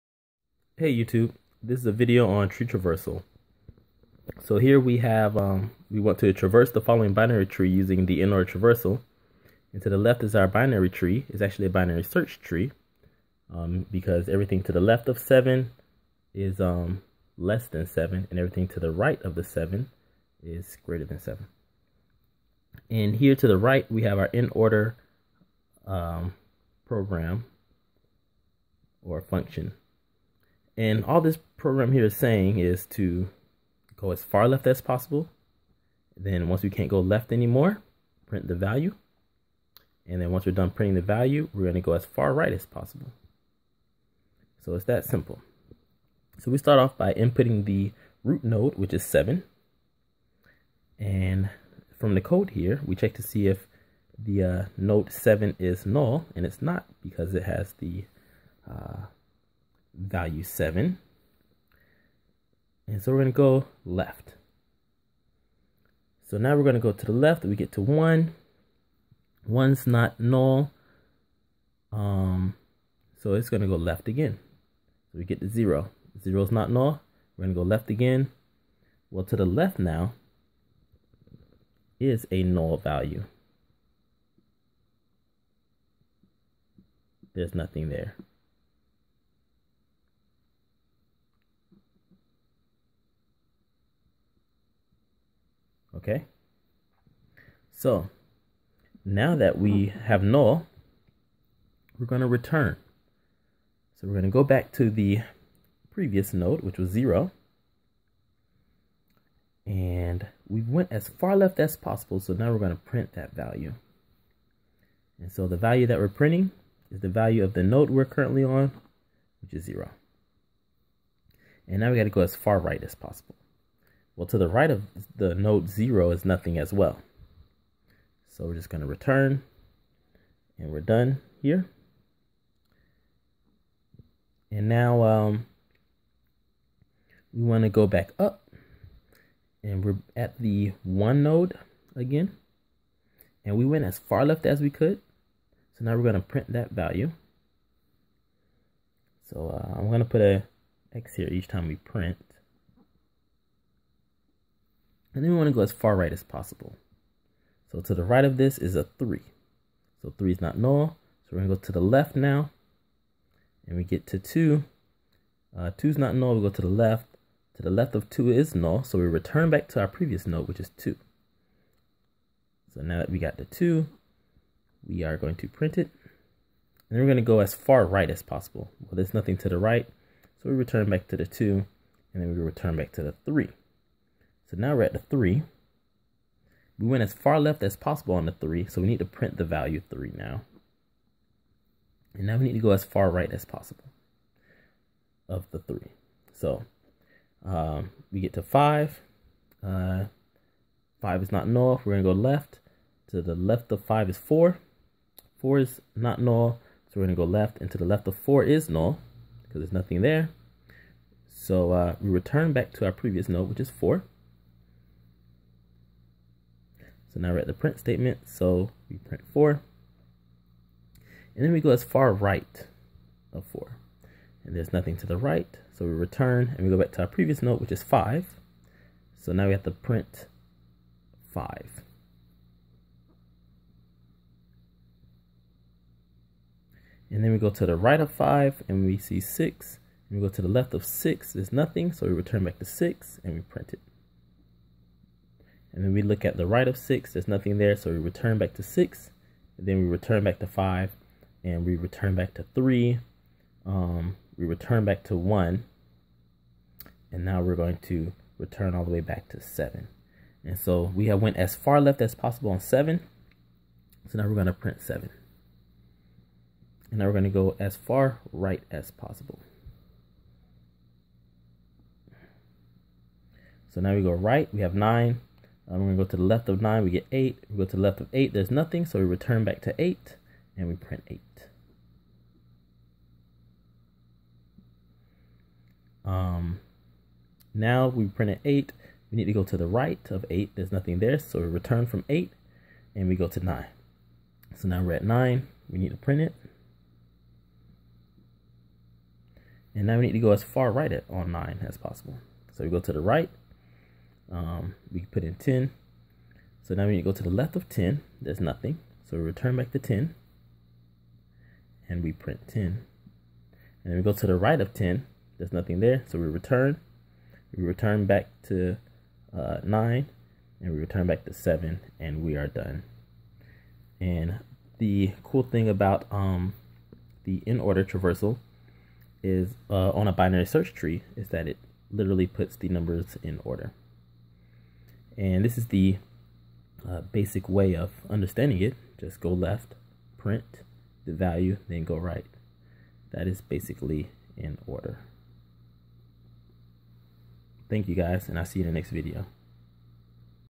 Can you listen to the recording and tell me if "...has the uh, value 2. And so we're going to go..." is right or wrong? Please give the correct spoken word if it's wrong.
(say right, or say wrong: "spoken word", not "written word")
wrong: "7", not "2".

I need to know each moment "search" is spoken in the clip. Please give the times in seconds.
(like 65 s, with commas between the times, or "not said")
12 s, 330 s.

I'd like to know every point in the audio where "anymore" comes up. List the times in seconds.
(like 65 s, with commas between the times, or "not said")
37 s.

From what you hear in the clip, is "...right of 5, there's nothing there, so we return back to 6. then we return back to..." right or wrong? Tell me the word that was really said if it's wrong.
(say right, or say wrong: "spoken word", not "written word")
wrong: "6", not "5".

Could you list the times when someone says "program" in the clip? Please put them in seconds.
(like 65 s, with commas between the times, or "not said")
26 s, 31 s.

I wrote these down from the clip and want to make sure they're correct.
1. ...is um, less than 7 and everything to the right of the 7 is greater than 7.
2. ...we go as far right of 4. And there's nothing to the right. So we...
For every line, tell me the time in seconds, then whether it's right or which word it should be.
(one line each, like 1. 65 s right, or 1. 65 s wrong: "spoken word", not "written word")
1. 16 s right
2. 221 s right.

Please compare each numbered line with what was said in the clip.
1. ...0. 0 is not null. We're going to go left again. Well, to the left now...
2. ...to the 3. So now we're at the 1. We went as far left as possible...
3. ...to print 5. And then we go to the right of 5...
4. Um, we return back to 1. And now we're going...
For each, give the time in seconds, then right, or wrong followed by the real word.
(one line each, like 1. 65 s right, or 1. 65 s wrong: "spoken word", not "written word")
1. 75 s right
2. 182 s wrong: "3", not "1"
3. 229 s right
4. 253 s right.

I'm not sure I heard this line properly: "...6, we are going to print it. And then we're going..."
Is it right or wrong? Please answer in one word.
wrong.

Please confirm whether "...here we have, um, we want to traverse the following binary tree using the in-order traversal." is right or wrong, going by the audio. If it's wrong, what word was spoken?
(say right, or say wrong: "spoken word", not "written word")
right.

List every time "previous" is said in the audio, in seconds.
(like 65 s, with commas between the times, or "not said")
105 s, 169 s, 212 s, 227 s.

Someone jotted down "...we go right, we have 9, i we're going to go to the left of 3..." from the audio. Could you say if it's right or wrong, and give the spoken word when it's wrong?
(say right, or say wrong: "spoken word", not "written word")
wrong: "9", not "3".